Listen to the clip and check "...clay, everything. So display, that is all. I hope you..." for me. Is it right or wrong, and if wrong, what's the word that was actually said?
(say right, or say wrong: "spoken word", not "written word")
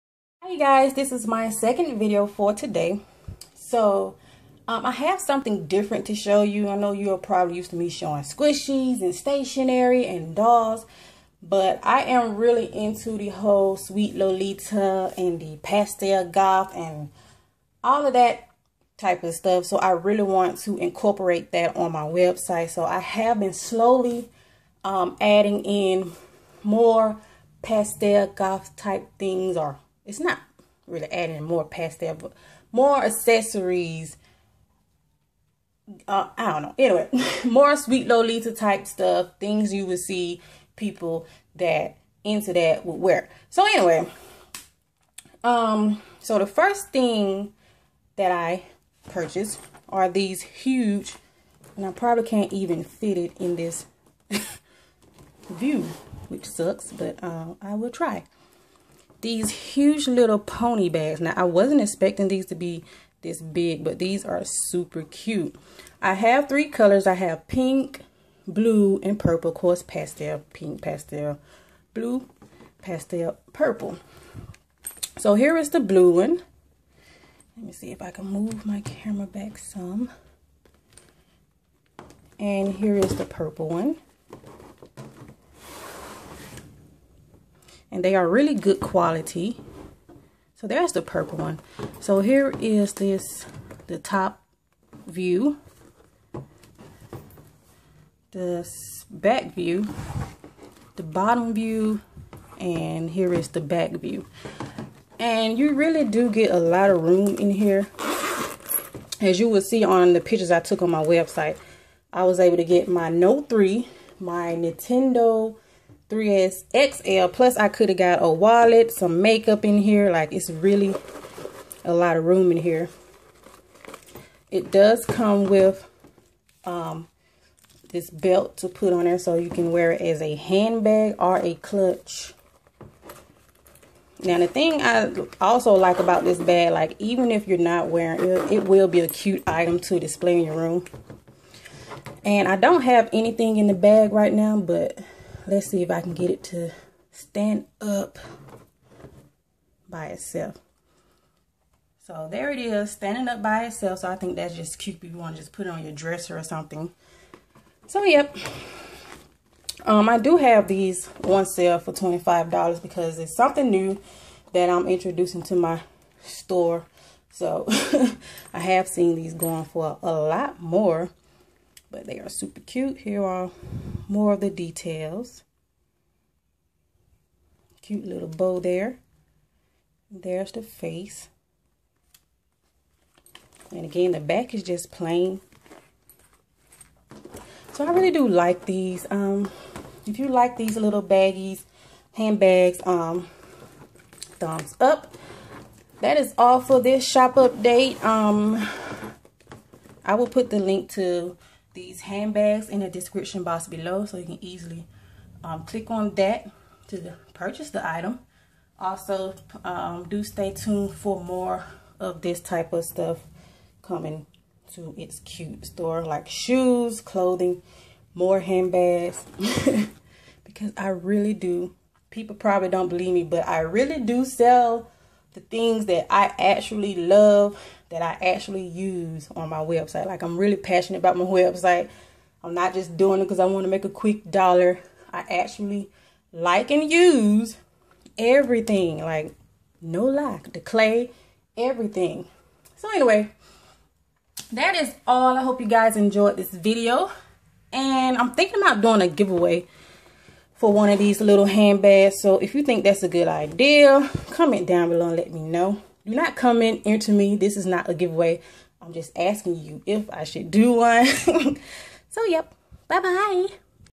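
wrong: "anyway", not "display".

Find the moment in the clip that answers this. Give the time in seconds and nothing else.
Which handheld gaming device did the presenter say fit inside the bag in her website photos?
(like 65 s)
114 s.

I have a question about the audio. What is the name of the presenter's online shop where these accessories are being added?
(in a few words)
It's Cute.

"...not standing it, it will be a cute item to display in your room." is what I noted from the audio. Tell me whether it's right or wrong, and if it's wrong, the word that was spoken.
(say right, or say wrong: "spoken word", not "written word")
wrong: "wearing", not "standing".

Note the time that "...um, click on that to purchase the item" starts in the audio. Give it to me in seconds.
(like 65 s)
205 s.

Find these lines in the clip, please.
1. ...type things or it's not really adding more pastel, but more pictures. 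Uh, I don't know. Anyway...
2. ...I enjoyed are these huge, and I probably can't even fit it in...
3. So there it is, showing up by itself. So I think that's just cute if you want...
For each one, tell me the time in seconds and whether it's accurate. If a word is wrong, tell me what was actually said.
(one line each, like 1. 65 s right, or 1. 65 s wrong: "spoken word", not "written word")
1. 28 s wrong: "accessories", not "pictures"
2. 48 s wrong: "purchased", not "enjoyed"
3. 152 s wrong: "standing", not "showing".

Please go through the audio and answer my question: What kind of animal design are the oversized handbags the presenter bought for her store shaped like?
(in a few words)
pony.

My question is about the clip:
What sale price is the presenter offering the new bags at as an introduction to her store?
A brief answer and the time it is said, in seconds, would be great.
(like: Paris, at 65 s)
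$25, at 161 s.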